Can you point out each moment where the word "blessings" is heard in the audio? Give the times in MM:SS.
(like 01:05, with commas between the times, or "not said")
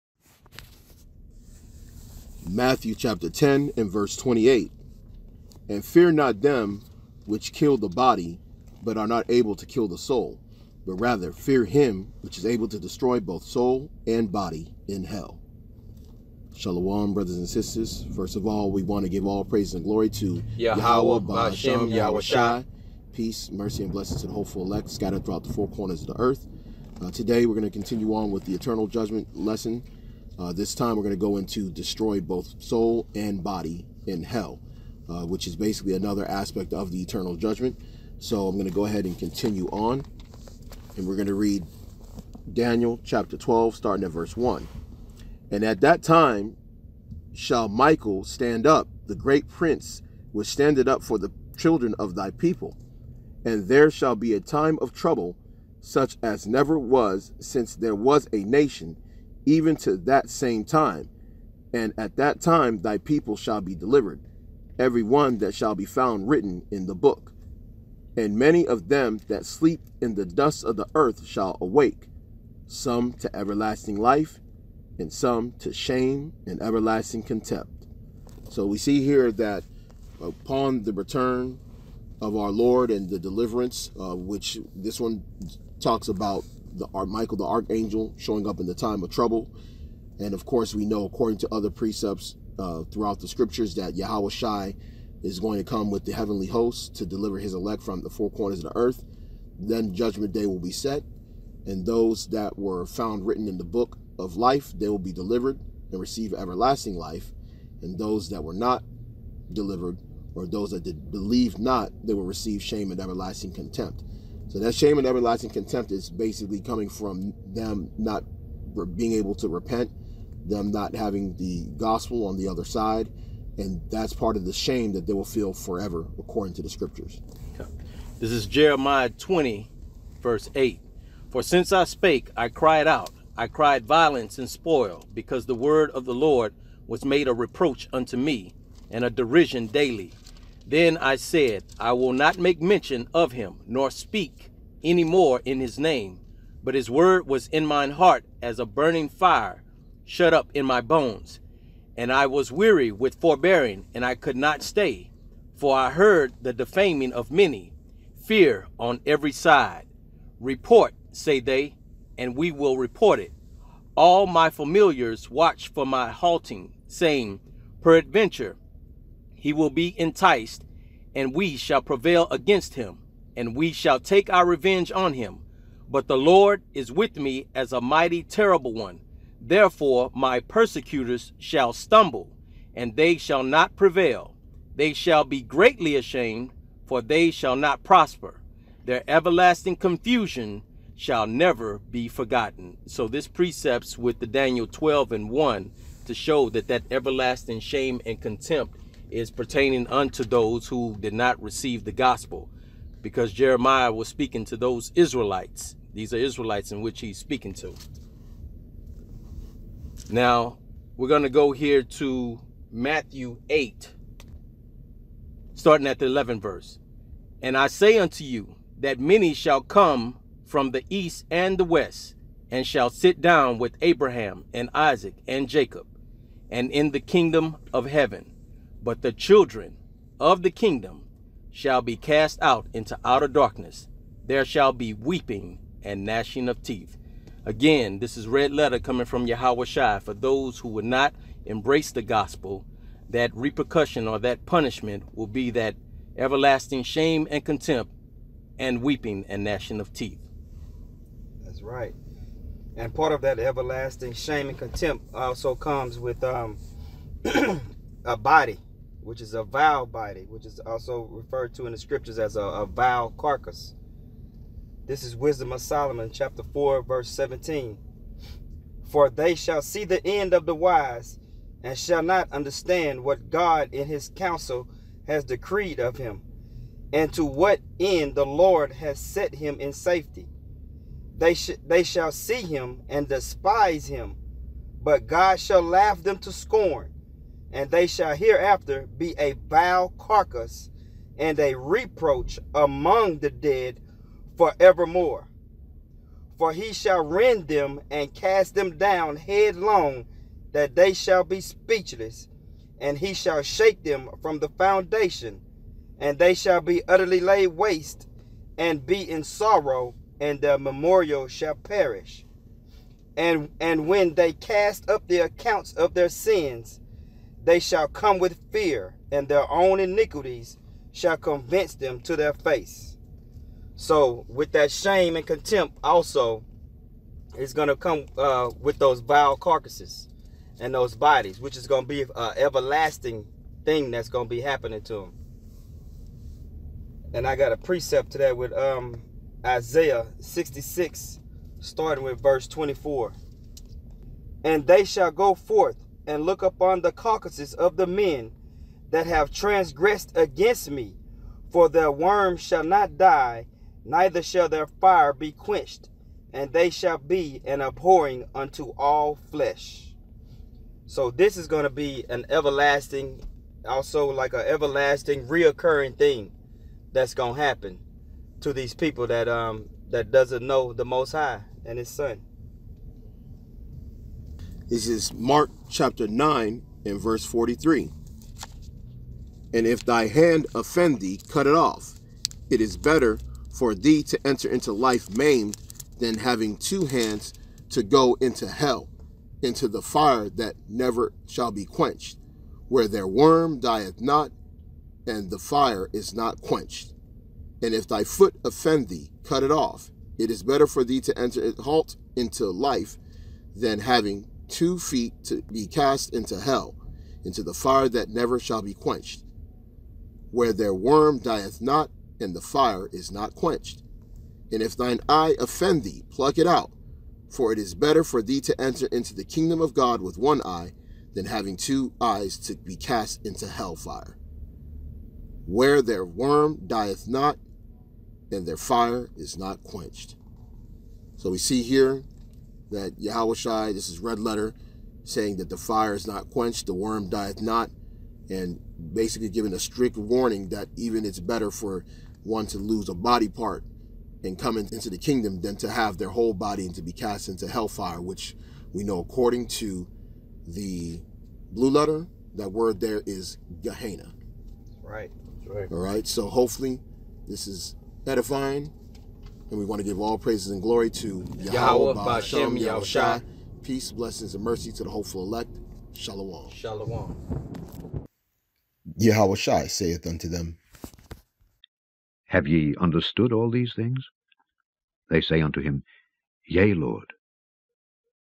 00:23, 07:43.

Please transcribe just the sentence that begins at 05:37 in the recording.
And I got a precept to that with um, Isaiah 66, starting with verse 24.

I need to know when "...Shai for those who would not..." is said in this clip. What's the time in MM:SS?
03:59.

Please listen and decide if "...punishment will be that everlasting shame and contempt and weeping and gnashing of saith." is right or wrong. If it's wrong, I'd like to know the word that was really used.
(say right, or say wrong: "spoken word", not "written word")
wrong: "teeth", not "saith".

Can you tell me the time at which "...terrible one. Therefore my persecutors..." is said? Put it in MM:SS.
02:58.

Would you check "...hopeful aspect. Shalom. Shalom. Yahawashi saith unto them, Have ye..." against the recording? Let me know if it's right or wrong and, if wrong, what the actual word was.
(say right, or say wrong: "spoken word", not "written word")
wrong: "elect", not "aspect".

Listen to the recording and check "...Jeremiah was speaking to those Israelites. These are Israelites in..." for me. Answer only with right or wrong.
right.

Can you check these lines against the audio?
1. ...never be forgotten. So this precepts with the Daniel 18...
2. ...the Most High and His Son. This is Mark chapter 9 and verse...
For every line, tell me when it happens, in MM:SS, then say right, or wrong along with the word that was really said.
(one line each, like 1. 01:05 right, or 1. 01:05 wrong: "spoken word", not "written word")
1. 03:11 wrong: "12", not "18"
2. 06:10 right.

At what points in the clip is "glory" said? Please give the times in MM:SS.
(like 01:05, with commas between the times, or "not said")
00:19, 07:40.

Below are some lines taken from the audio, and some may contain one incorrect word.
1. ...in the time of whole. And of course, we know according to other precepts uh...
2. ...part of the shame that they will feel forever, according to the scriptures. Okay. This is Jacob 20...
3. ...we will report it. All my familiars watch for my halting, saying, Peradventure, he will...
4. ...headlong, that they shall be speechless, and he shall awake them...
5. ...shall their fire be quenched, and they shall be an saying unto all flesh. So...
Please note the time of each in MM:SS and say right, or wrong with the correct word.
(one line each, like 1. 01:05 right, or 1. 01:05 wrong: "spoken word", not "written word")
1. 01:28 wrong: "trouble", not "whole"
2. 02:04 wrong: "Jeremiah", not "Jacob"
3. 02:42 right
4. 04:59 wrong: "shake", not "awake"
5. 05:54 wrong: "abhorring", not "saying".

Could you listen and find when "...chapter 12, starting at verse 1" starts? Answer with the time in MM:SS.
00:43.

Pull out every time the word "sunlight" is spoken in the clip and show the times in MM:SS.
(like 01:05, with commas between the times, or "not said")
not said.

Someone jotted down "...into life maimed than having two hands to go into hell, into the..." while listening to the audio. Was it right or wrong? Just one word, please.
right.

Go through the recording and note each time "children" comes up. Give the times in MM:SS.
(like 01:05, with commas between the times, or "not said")
00:51, 03:49.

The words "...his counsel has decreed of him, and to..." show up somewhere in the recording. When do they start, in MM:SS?
04:33.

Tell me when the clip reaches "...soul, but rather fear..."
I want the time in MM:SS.
00:09.